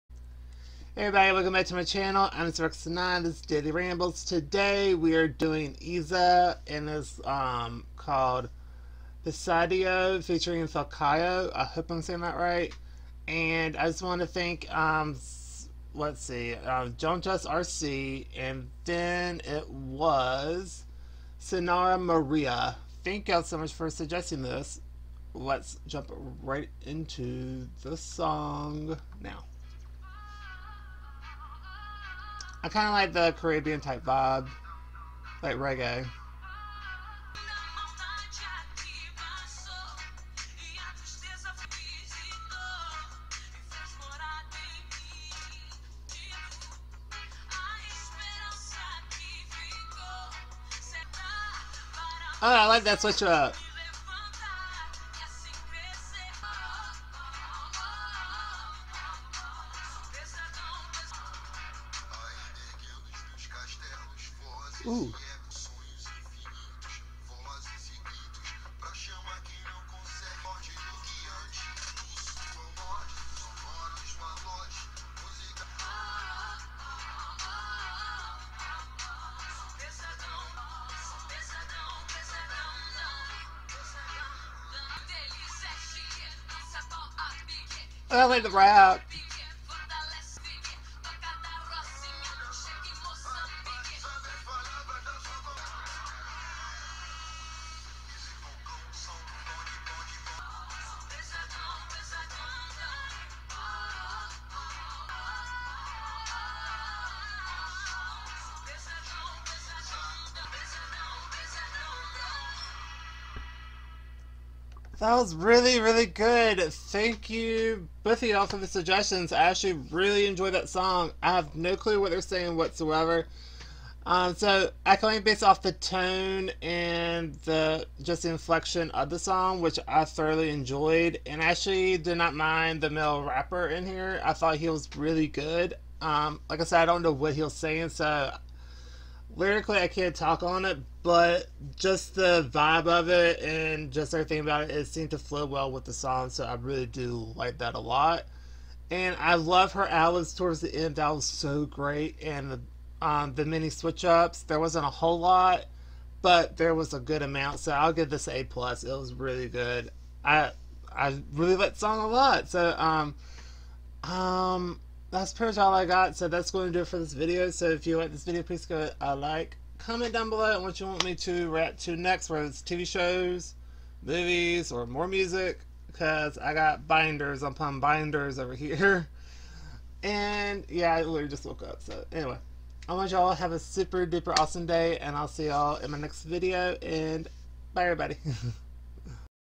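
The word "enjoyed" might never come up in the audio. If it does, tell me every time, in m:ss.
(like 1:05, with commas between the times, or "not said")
2:00, 2:10.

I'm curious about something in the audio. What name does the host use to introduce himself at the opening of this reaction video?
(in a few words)
Rex9.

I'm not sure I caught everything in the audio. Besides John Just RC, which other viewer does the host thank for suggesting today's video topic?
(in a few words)
Sonara Maria.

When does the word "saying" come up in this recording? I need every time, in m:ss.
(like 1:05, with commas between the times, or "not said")
0:12, 2:02, 2:17.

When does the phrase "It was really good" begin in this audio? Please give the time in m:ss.
2:38.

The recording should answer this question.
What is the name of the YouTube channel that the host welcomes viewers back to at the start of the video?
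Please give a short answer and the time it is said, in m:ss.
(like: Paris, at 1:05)
Daily Rambles, at 0:03.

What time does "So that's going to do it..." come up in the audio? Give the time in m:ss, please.
2:46.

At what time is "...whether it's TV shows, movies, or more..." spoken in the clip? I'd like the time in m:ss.
2:52.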